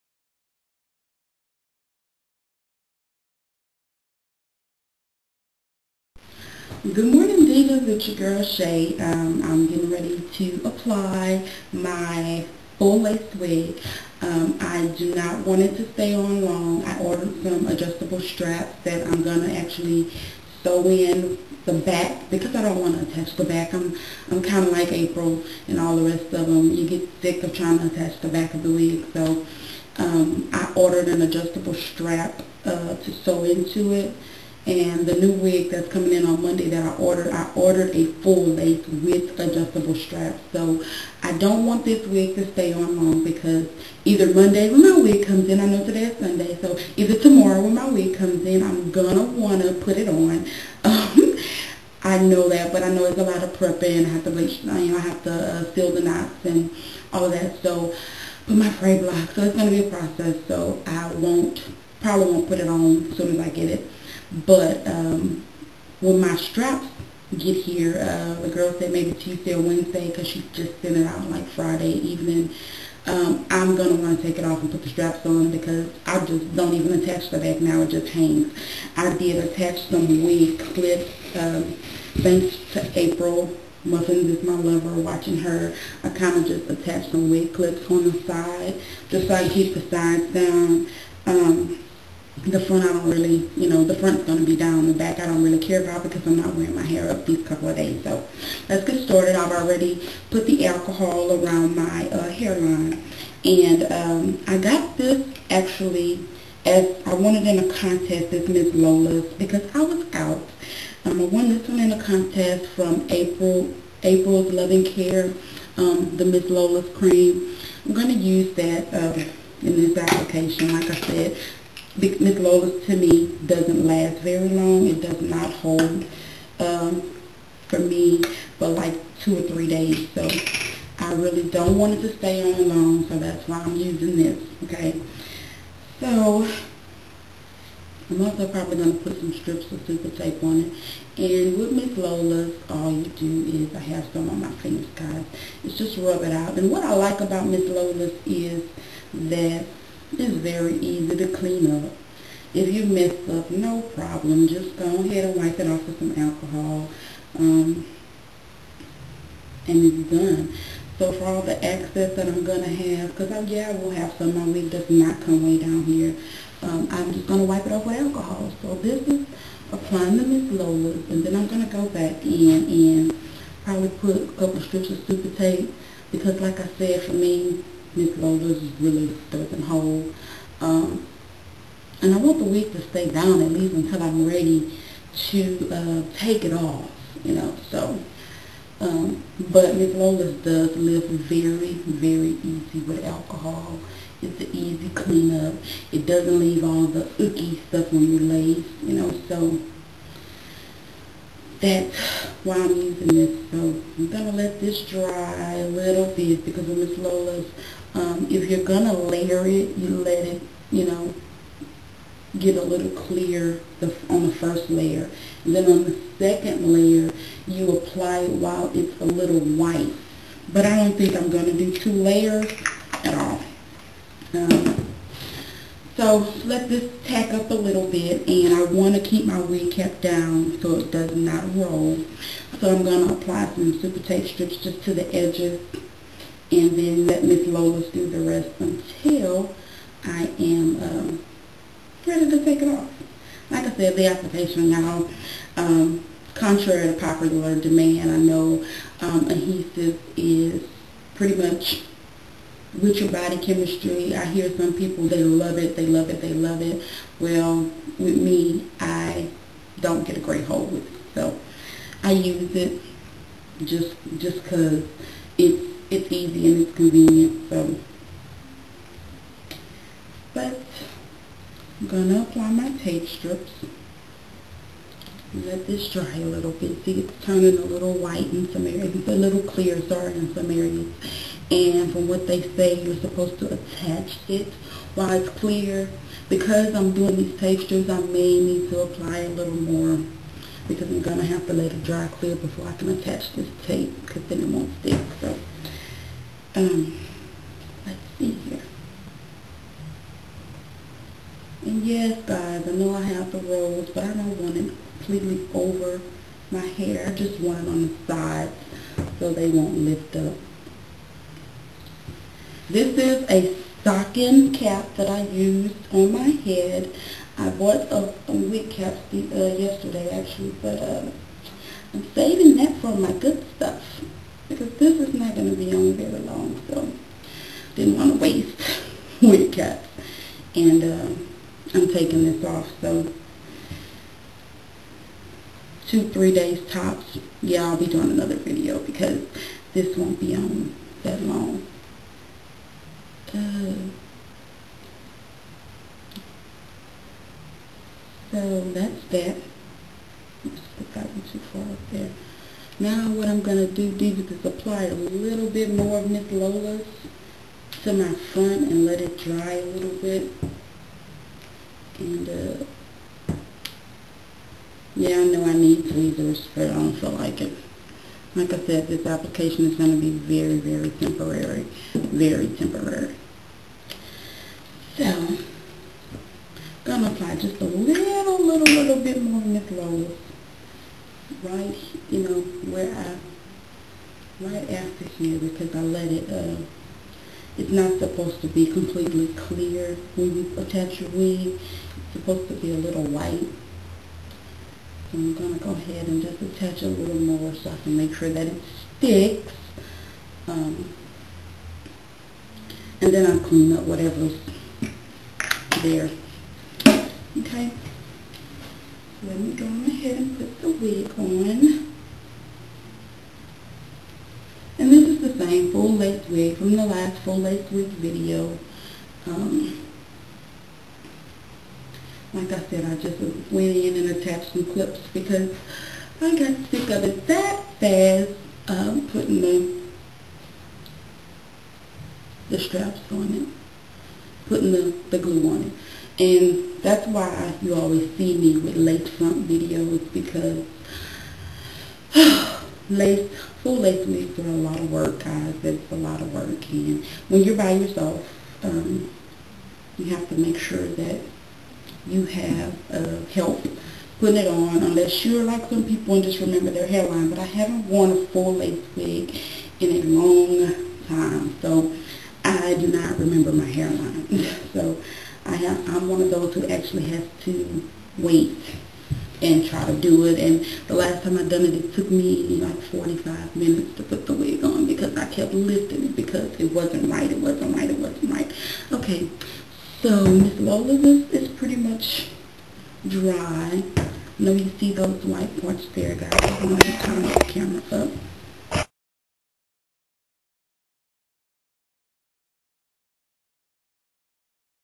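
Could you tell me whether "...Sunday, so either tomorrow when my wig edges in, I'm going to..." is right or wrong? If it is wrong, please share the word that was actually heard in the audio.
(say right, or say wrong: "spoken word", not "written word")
wrong: "comes", not "edges".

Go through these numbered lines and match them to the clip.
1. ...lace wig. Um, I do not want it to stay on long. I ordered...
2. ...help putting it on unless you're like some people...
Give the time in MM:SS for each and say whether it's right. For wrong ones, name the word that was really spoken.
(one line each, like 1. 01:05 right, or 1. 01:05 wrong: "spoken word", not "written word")
1. 00:13 right
2. 07:33 right.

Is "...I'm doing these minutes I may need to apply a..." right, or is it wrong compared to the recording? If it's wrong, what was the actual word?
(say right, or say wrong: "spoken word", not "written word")
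wrong: "textures", not "minutes".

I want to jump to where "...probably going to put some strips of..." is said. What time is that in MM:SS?
02:18.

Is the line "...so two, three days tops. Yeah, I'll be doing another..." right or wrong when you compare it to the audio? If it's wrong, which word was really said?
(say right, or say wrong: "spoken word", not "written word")
right.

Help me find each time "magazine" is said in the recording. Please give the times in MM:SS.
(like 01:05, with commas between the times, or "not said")
not said.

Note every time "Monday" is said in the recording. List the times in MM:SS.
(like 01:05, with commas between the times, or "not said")
00:36, 00:44.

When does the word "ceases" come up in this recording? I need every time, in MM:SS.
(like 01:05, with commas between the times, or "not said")
not said.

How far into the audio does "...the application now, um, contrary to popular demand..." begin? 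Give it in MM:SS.
04:03.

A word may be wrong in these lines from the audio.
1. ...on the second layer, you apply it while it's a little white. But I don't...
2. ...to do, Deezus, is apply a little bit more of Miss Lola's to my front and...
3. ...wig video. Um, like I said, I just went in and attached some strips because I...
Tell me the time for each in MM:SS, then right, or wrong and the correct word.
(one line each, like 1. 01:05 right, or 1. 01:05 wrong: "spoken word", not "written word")
1. 03:35 right
2. 05:53 right
3. 06:57 wrong: "clips", not "strips".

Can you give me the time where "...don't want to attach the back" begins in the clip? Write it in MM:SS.
00:22.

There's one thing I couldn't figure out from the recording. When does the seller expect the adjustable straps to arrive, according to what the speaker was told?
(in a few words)
Tuesday or Wednesday.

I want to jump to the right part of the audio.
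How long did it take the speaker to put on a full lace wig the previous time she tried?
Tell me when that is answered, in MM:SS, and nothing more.
07:52.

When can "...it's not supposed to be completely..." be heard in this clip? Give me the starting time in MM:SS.
06:27.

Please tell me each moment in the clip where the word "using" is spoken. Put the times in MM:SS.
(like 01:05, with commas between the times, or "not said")
02:13, 03:22.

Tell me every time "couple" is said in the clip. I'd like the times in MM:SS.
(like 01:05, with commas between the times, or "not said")
01:37, 02:54.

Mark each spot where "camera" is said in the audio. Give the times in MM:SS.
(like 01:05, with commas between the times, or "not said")
08:07.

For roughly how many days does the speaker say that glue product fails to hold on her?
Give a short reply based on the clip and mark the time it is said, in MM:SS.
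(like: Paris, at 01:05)
2 or 3 days, at 02:09.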